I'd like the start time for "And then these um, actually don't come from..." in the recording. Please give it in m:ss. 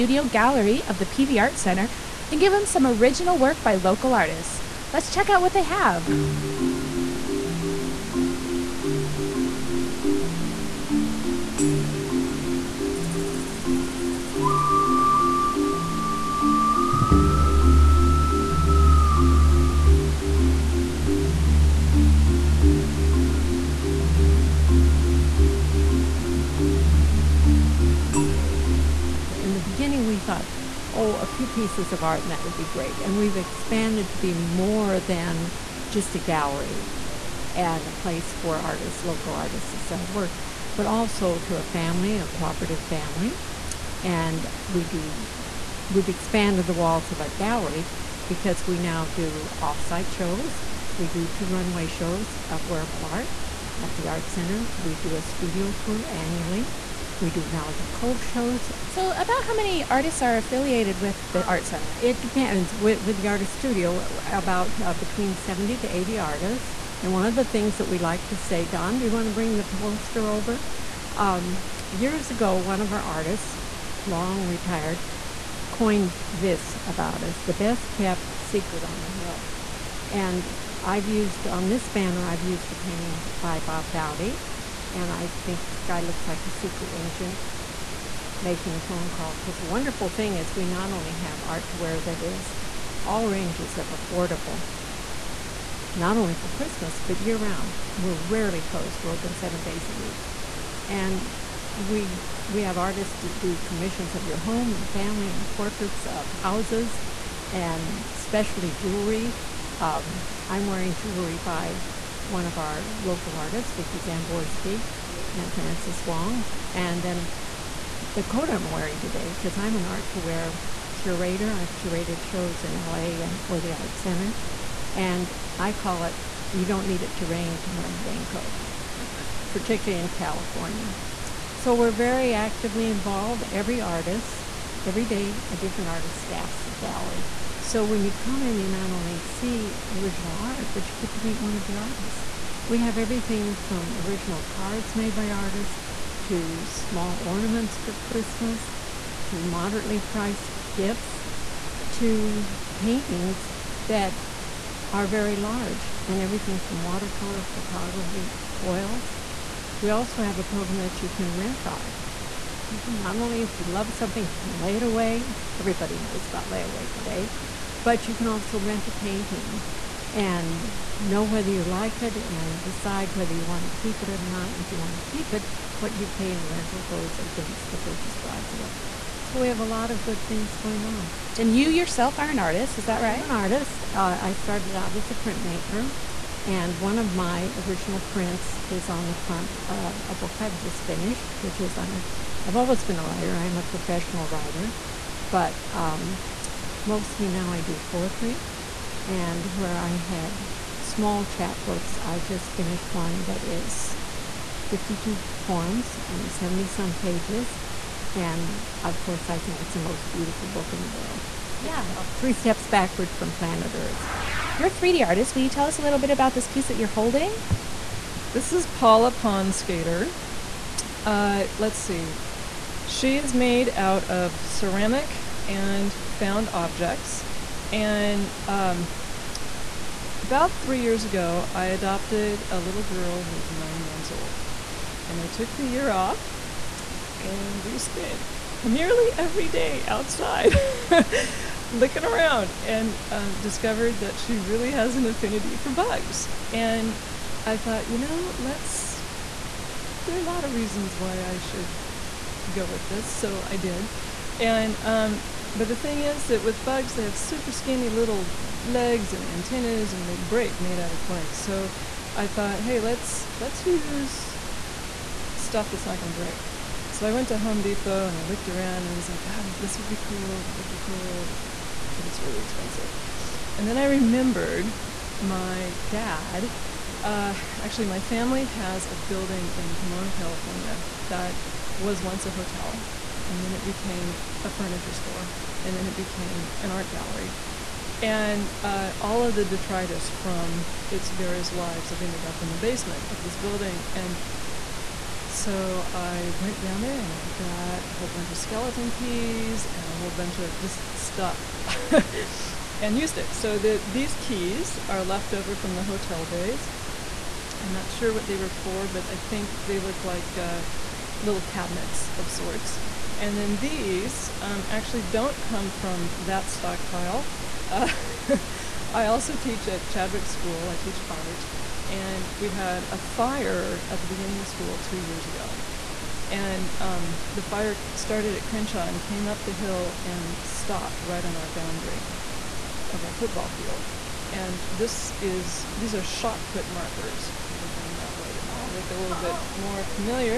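5:13.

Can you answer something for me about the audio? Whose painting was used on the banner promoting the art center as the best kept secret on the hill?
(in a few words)
Bob Dowdy.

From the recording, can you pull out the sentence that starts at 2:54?
And if you want to keep it, what you pay in rental goes against the purchase price of it.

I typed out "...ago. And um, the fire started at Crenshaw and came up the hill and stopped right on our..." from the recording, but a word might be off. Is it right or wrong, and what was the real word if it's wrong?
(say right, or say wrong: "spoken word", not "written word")
right.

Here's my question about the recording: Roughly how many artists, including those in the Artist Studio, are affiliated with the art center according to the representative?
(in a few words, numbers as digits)
70 to 80.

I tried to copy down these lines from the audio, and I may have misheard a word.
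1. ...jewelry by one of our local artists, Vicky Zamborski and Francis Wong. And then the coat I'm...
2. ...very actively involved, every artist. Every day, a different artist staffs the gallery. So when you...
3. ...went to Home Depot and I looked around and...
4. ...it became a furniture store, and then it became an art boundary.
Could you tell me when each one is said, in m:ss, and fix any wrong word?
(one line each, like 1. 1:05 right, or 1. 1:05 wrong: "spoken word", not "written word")
1. 1:50 right
2. 2:11 right
3. 4:27 right
4. 4:43 wrong: "gallery", not "boundary".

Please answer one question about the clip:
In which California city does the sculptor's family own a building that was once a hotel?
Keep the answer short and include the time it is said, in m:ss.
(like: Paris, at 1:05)
Pomona, at 4:39.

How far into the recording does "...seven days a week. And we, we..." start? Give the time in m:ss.
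1:39.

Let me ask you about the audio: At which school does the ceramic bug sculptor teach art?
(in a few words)
Chadwick School.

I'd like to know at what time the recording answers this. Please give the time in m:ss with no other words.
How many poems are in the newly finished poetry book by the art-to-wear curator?
3:24.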